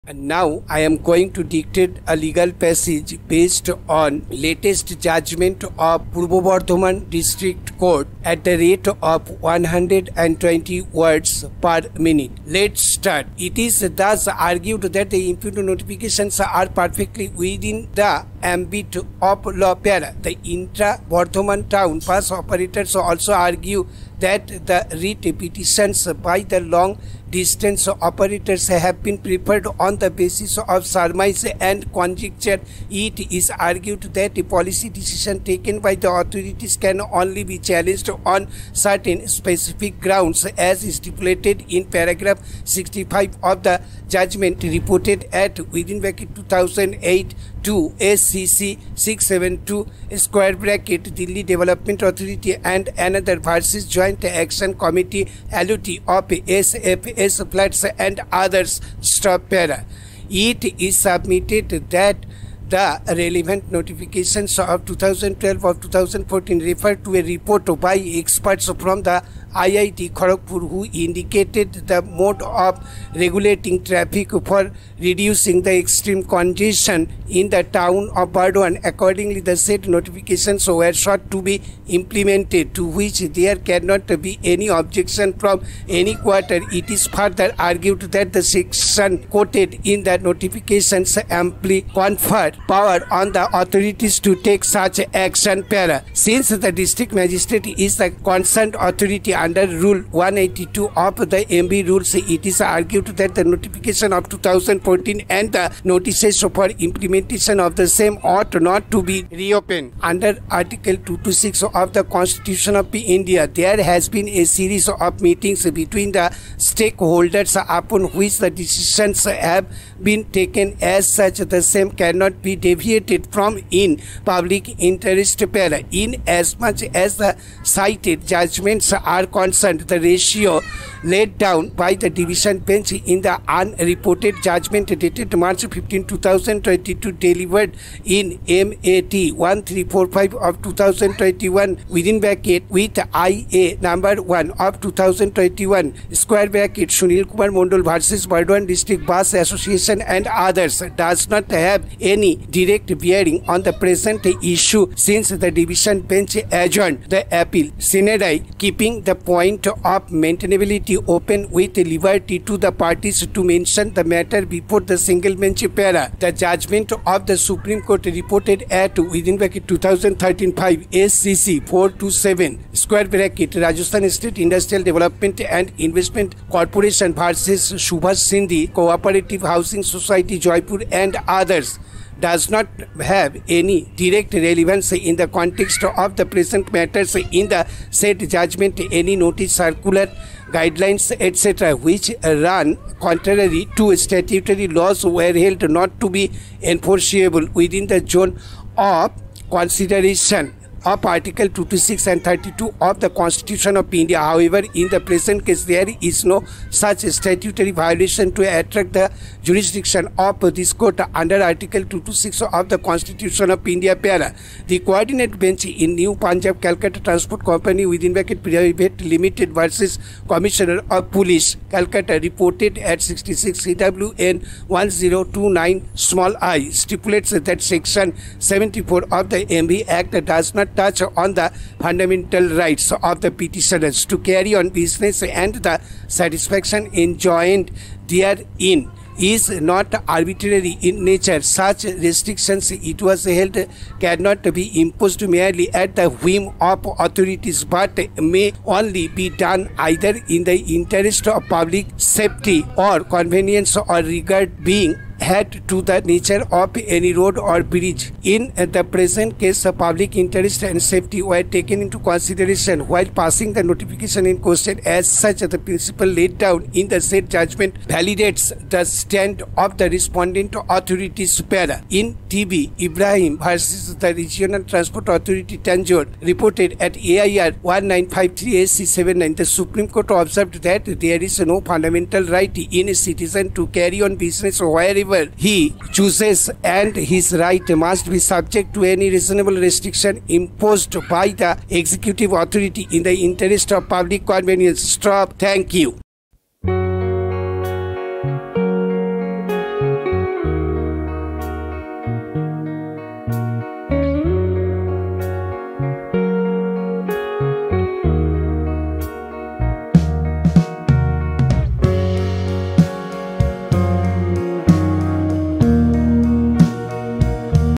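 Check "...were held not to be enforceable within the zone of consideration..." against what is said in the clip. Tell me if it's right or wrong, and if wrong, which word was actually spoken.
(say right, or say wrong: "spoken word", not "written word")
right.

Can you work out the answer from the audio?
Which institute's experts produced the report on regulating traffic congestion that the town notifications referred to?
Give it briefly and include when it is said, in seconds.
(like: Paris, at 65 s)
IIT Kharagpur, at 69 s.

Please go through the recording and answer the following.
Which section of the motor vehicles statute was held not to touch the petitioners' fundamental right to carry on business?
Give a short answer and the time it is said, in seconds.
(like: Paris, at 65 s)
Section 74, at 227 s.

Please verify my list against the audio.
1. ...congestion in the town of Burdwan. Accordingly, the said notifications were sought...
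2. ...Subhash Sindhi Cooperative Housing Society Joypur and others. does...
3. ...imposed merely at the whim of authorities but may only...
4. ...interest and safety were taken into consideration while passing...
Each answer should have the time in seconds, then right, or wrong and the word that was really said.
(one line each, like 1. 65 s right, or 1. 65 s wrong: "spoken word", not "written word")
1. 76 s right
2. 177 s right
3. 244 s right
4. 260 s right.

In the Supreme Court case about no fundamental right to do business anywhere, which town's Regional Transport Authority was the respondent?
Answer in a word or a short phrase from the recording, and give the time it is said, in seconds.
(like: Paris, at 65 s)
Tanjore, at 275 s.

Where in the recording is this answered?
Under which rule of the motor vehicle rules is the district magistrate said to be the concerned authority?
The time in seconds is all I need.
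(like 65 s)
99 s.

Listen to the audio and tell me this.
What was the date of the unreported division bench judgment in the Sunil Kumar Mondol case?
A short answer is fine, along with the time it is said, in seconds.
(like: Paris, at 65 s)
March 15, 2022, at 135 s.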